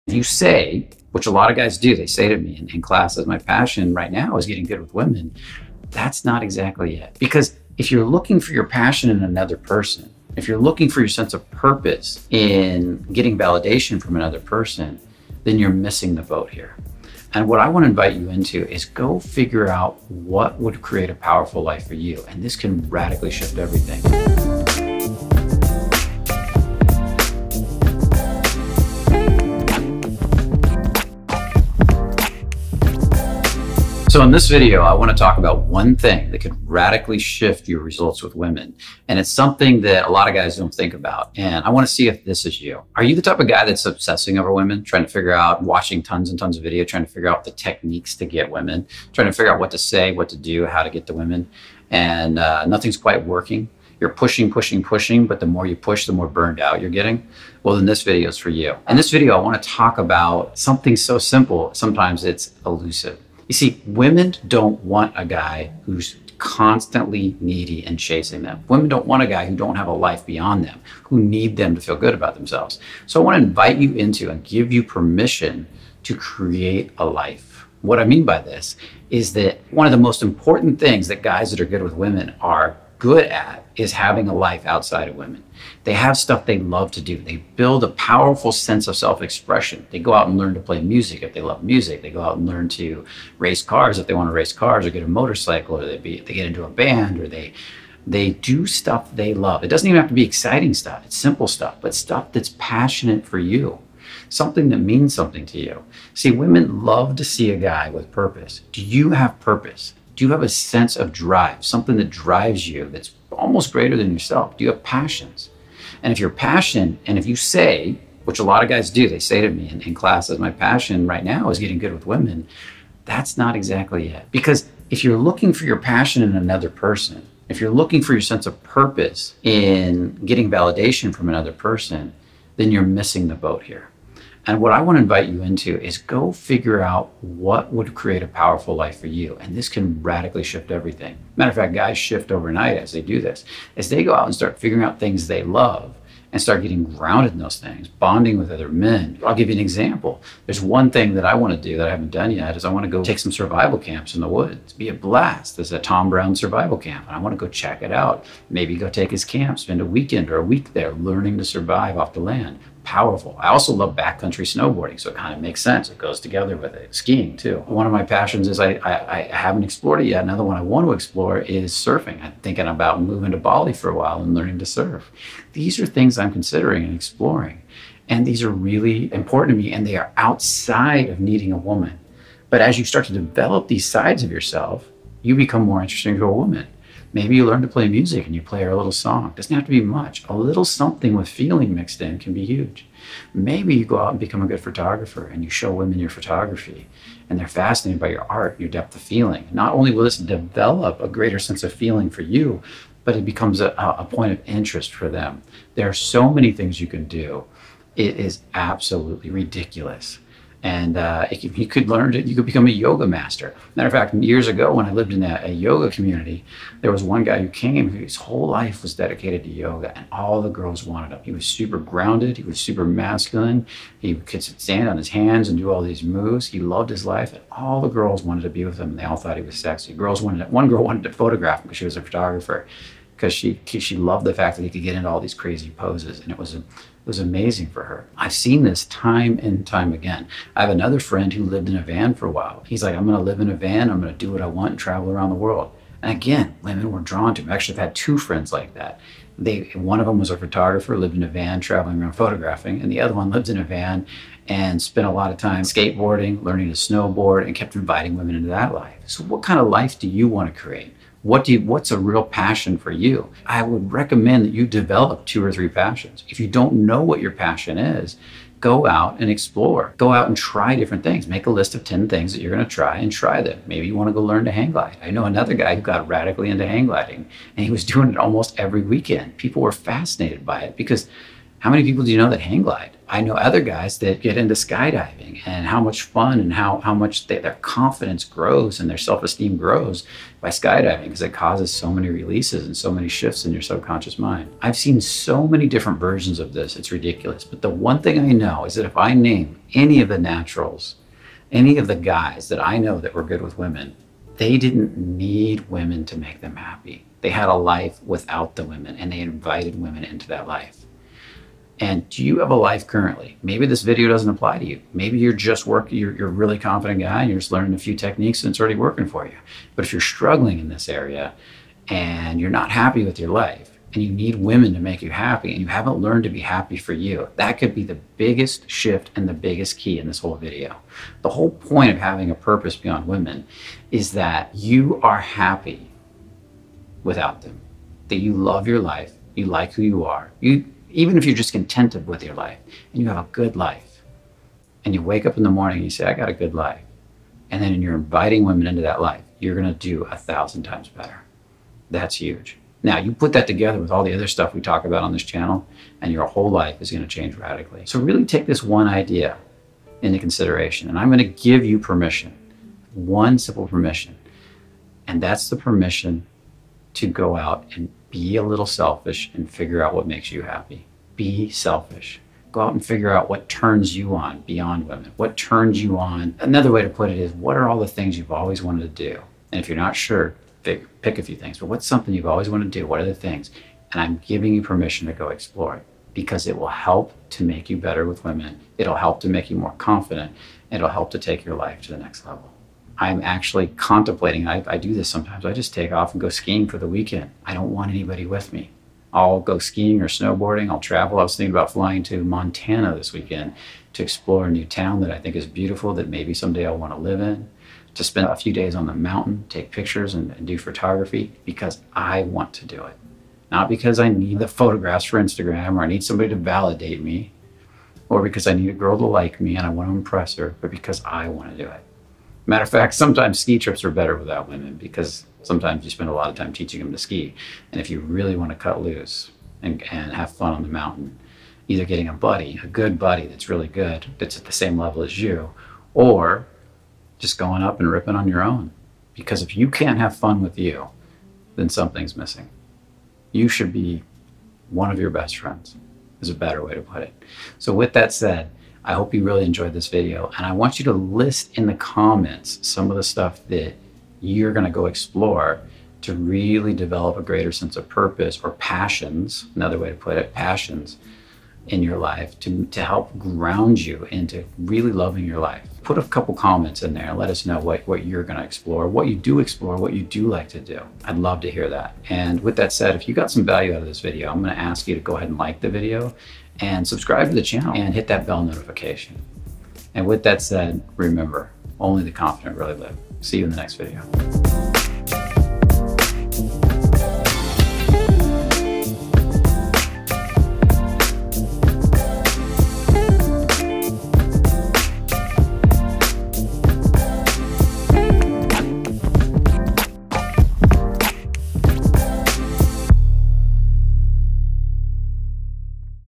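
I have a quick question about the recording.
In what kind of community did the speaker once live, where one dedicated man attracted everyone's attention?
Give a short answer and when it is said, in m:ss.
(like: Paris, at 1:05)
yoga community, at 3:35.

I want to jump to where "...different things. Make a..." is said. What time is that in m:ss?
4:30.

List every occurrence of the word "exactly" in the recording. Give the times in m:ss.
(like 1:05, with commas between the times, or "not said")
0:06, 2:03.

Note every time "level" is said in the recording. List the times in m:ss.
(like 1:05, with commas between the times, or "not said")
6:32, 7:14.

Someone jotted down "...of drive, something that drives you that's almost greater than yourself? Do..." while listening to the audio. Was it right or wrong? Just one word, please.
right.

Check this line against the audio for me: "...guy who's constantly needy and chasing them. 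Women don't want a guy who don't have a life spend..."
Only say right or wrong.
wrong.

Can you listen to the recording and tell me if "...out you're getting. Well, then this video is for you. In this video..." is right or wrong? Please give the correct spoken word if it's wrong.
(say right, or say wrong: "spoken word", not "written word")
right.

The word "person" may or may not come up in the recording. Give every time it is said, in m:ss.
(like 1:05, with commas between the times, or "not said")
0:09, 0:14, 2:06, 2:11.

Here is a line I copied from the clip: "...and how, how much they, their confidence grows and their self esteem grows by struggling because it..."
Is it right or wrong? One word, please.
wrong.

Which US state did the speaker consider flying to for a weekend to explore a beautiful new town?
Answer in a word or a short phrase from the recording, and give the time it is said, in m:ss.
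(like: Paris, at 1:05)
Montana, at 6:42.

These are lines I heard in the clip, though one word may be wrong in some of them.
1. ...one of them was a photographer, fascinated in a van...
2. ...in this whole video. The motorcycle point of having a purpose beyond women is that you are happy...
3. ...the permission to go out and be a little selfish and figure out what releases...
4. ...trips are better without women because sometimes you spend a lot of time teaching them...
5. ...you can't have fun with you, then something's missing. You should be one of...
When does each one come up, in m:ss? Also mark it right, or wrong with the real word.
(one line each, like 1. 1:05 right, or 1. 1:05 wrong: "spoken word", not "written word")
1. 4:09 wrong: "lived", not "fascinated"
2. 5:29 wrong: "whole", not "motorcycle"
3. 6:05 wrong: "makes", not "releases"
4. 7:03 right
5. 7:19 right.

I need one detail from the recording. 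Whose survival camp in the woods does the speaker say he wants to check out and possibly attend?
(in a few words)
Tom Brown.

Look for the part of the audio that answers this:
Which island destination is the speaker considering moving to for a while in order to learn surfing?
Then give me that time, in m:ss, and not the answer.
2:53.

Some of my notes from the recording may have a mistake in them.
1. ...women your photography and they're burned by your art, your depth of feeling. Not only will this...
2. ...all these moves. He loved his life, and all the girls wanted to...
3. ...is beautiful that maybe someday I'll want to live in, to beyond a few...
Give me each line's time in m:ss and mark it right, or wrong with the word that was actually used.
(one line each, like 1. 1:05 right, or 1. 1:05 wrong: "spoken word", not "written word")
1. 3:15 wrong: "fascinated", not "burned"
2. 3:45 right
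3. 6:45 wrong: "spend", not "beyond".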